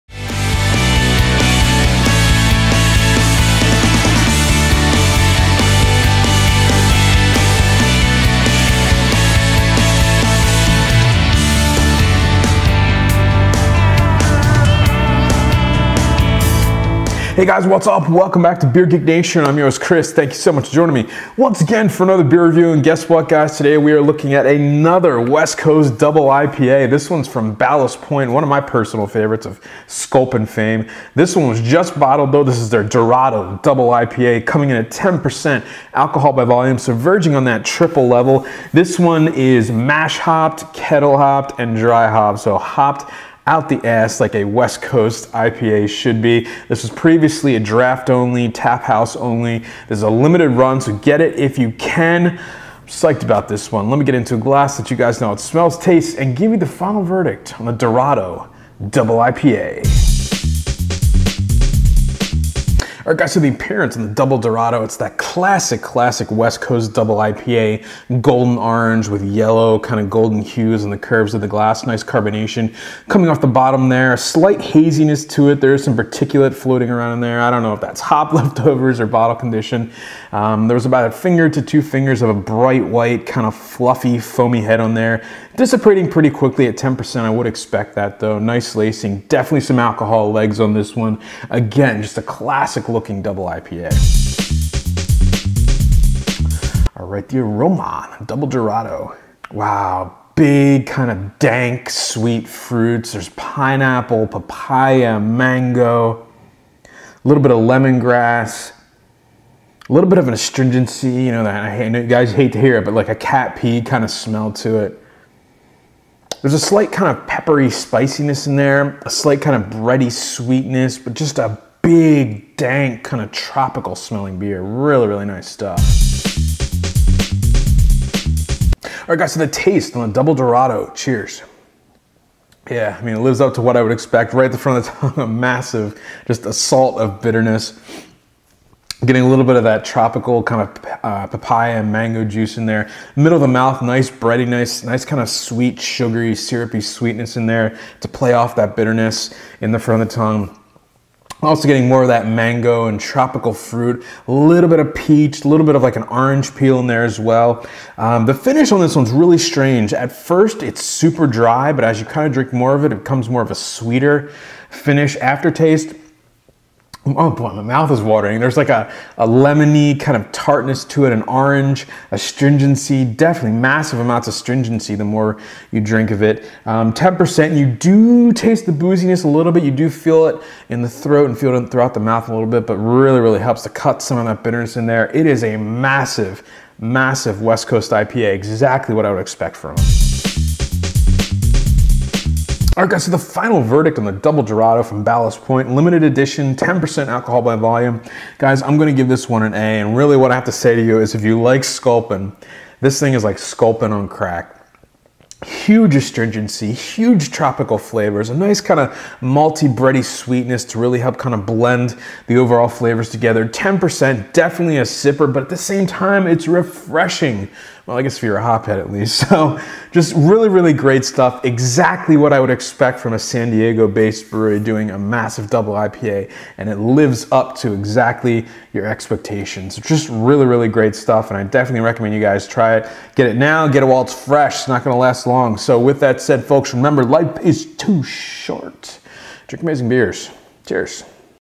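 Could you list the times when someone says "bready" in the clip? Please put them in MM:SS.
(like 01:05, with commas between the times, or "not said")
01:59, 02:24, 03:29.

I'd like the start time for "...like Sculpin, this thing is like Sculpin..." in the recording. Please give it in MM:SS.
03:21.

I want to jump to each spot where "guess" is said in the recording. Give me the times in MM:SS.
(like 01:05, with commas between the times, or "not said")
00:22, 03:38.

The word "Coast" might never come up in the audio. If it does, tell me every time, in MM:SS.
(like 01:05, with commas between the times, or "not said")
00:25, 00:44, 01:06, 03:07.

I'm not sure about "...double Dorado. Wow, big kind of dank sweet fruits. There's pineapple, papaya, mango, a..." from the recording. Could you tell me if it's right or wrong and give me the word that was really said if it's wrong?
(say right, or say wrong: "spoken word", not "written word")
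right.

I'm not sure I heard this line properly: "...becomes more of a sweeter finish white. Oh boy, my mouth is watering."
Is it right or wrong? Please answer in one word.
wrong.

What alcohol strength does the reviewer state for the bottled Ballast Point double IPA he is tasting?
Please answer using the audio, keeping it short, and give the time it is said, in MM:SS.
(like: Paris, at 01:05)
10%, at 00:34.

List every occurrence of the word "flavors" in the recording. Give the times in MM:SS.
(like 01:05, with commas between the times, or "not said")
03:27, 03:32.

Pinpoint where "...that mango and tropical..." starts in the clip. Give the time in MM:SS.
02:32.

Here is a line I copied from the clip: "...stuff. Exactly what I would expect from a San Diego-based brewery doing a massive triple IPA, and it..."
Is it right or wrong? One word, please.
wrong.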